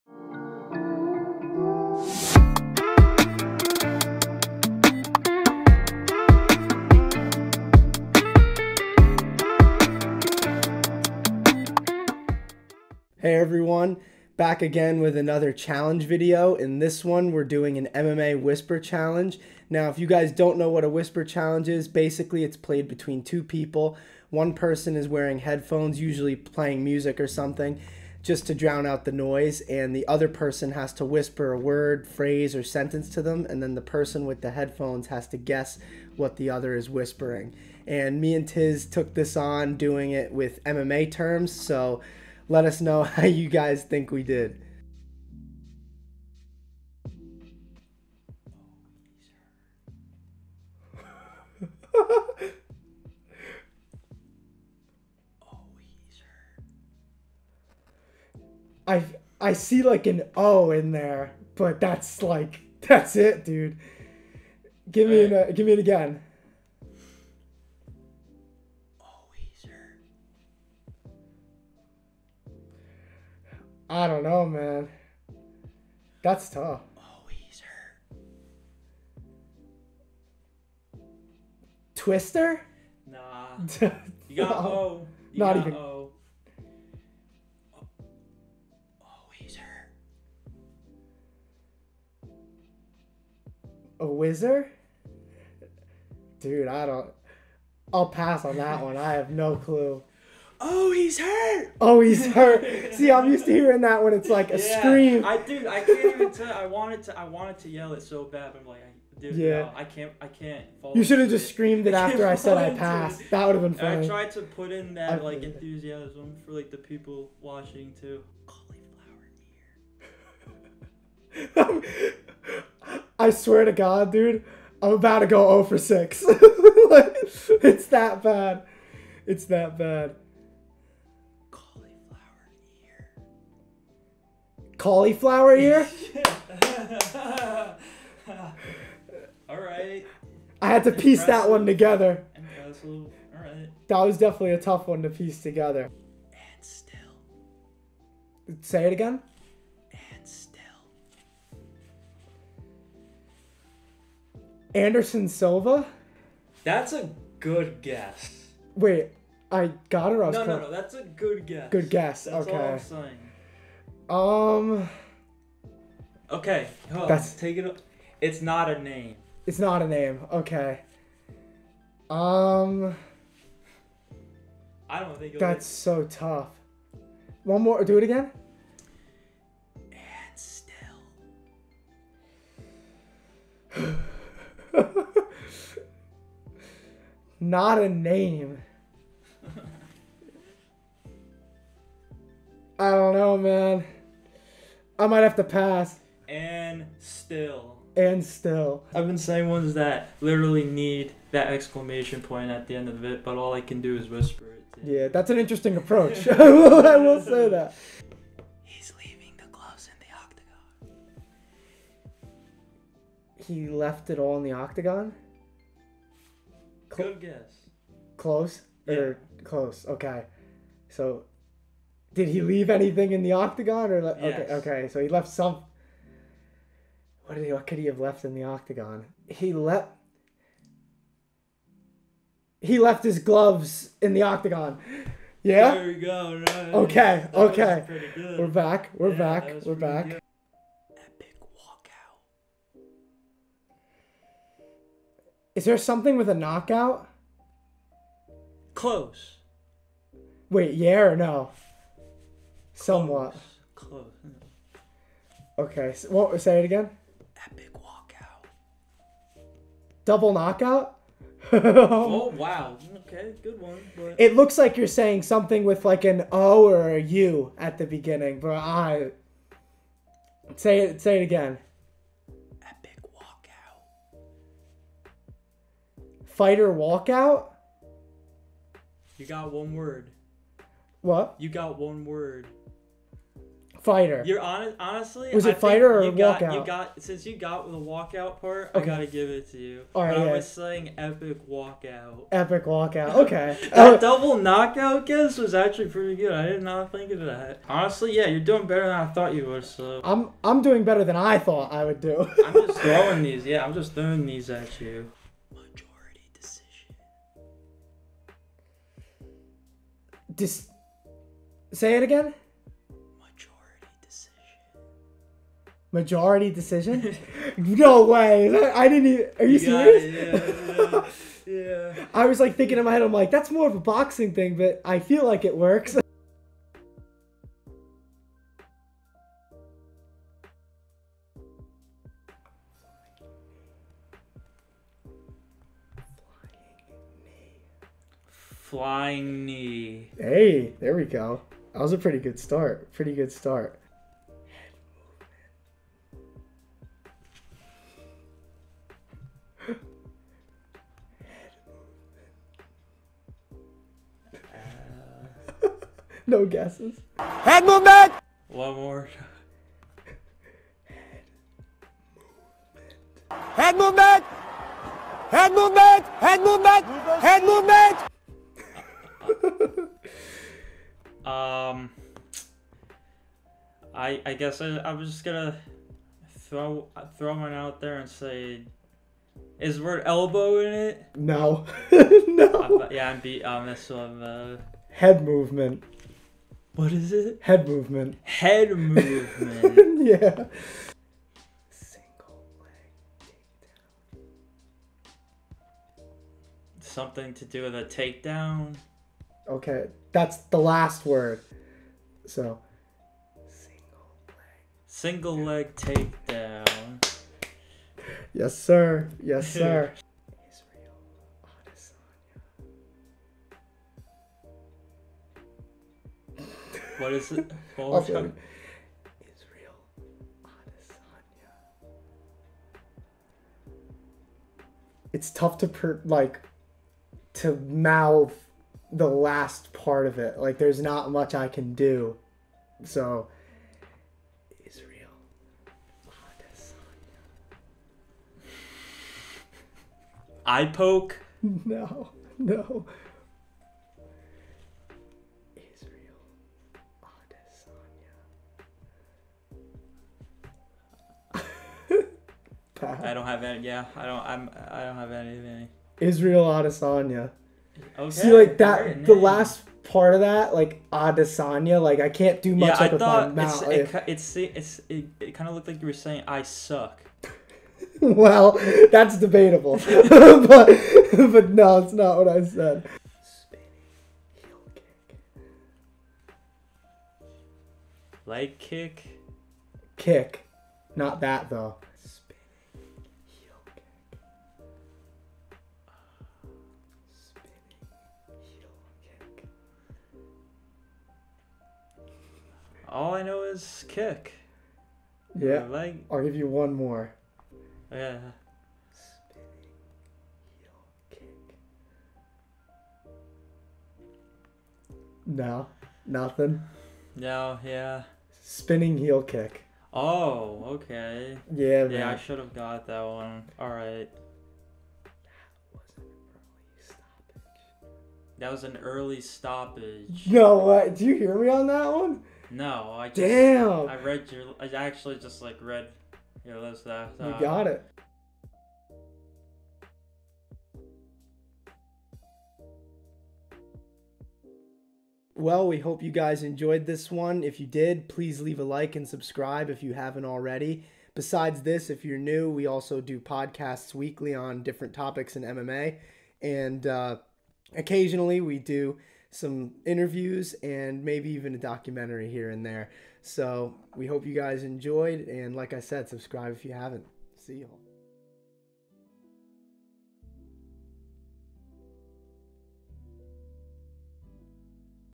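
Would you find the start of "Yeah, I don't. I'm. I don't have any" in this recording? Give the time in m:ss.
7:33.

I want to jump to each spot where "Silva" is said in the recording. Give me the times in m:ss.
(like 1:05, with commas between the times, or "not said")
2:35.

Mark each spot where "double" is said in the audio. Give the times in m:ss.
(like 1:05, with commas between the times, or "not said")
4:20, 4:53.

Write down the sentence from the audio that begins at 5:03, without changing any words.
Yeah, I'm just throwing these at you.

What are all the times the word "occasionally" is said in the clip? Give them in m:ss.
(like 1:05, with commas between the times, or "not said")
9:07.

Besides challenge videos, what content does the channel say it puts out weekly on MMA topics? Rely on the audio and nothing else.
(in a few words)
Podcasts.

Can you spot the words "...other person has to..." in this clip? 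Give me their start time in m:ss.
0:30.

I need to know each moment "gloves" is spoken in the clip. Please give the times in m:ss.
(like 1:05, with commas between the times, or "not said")
3:29, 3:53.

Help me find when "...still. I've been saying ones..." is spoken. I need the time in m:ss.
3:18.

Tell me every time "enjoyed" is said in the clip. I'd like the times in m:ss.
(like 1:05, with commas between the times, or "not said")
8:56, 9:14.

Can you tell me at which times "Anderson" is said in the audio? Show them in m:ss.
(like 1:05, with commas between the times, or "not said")
2:34.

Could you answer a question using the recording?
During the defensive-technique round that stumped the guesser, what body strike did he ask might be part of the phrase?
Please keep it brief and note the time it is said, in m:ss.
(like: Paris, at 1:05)
Elbow, at 6:19.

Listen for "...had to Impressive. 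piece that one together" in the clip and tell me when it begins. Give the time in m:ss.
2:20.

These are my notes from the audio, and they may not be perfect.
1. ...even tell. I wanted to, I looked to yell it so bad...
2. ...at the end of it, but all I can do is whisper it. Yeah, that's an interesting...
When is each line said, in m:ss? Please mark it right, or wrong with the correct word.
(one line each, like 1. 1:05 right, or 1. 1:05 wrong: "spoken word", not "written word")
1. 1:46 wrong: "wanted", not "looked"
2. 3:22 right.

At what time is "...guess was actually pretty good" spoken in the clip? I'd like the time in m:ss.
4:55.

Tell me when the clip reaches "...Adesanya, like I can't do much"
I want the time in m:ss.
7:40.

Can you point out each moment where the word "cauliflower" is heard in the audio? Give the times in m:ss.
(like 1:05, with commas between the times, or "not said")
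2:01, 2:14.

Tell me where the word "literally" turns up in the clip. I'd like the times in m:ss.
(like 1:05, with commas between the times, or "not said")
3:20.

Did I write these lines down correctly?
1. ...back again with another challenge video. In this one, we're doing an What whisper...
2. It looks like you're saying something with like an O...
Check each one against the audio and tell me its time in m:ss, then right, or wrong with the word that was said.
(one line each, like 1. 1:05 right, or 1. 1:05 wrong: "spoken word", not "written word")
1. 0:14 wrong: "MMA", not "What"
2. 4:24 right.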